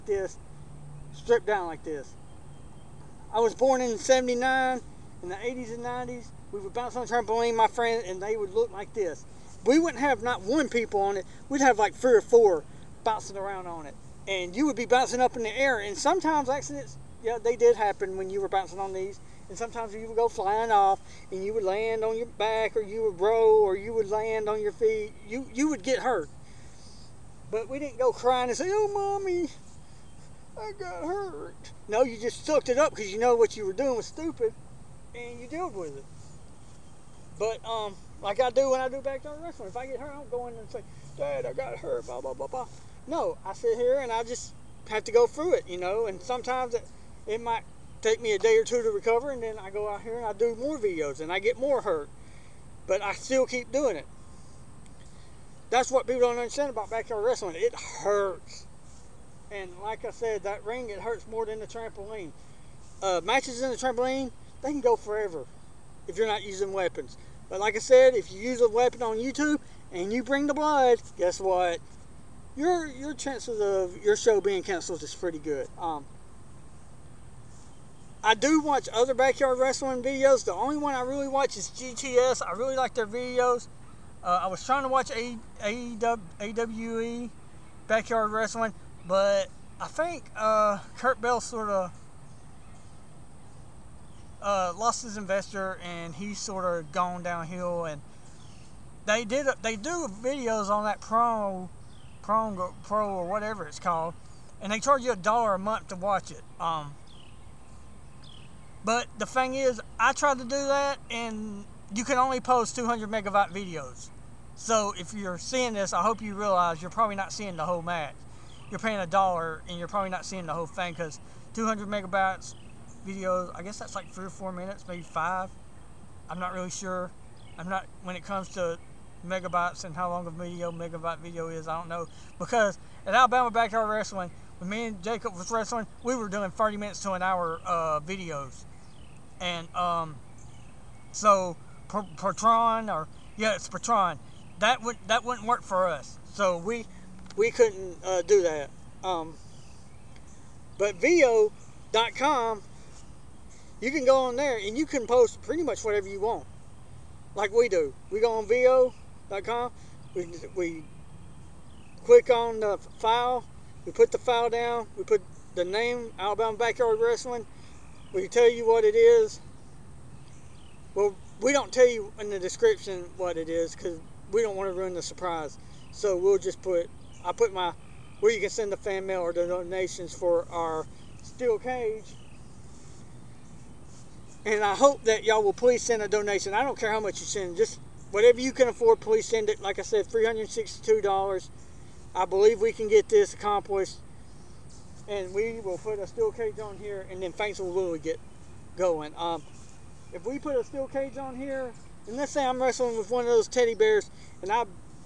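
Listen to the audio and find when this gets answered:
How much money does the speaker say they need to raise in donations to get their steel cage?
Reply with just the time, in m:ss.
3:10.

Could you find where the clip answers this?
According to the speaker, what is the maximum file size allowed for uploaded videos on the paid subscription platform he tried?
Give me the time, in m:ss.
1:52.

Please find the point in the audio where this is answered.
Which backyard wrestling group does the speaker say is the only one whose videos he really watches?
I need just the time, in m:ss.
1:21.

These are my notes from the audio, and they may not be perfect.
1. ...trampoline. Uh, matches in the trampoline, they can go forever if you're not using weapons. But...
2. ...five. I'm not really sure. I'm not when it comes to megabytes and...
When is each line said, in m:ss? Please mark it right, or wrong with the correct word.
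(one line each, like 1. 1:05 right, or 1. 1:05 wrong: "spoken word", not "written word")
1. 1:01 right
2. 2:05 right.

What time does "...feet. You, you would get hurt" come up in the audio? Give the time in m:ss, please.
0:24.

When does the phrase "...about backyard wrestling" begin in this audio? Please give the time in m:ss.
0:56.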